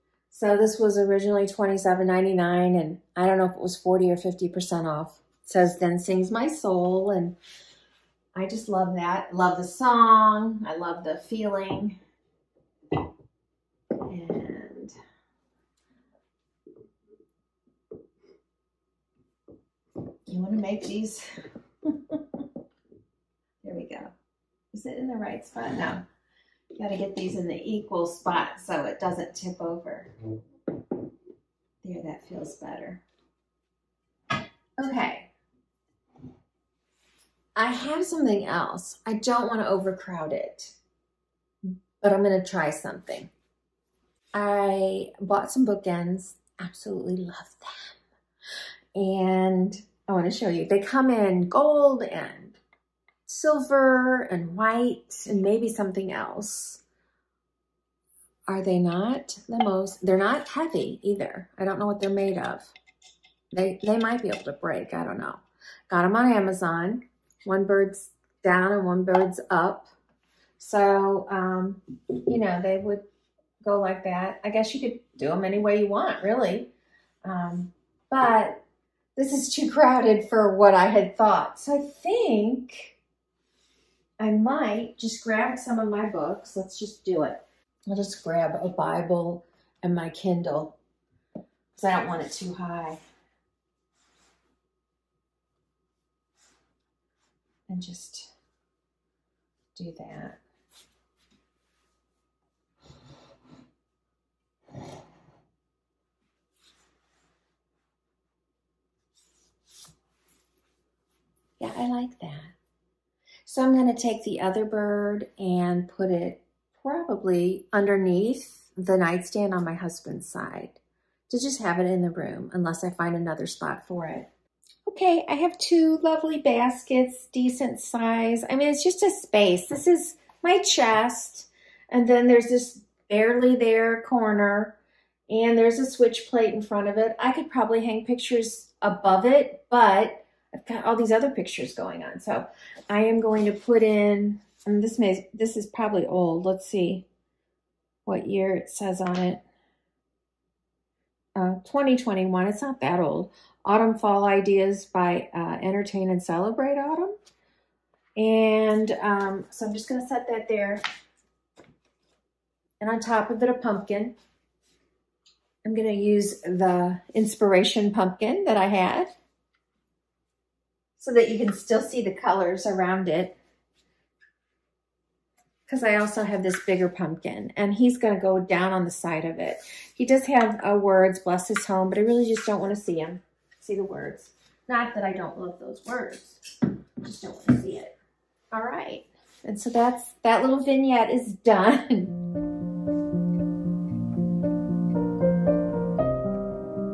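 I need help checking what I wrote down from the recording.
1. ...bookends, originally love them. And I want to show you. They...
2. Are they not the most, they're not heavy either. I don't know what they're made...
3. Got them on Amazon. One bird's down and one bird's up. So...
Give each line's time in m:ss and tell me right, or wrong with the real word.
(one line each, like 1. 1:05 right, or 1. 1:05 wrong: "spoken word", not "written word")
1. 0:45 wrong: "absolutely", not "originally"
2. 0:58 right
3. 1:05 right.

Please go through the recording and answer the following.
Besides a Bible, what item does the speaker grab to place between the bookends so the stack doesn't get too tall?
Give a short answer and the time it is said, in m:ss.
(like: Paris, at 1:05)
Kindle, at 1:30.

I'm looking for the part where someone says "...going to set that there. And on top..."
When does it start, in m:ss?
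2:39.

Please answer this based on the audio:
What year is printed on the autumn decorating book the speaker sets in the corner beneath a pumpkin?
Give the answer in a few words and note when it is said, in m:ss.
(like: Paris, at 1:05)
2021, at 2:31.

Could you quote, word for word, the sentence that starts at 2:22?
So I am going to put in, and this may, this is probably old.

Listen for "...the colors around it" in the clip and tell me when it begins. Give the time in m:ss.
2:52.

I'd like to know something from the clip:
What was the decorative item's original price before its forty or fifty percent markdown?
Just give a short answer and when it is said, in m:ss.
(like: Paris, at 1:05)
$27.99, at 0:01.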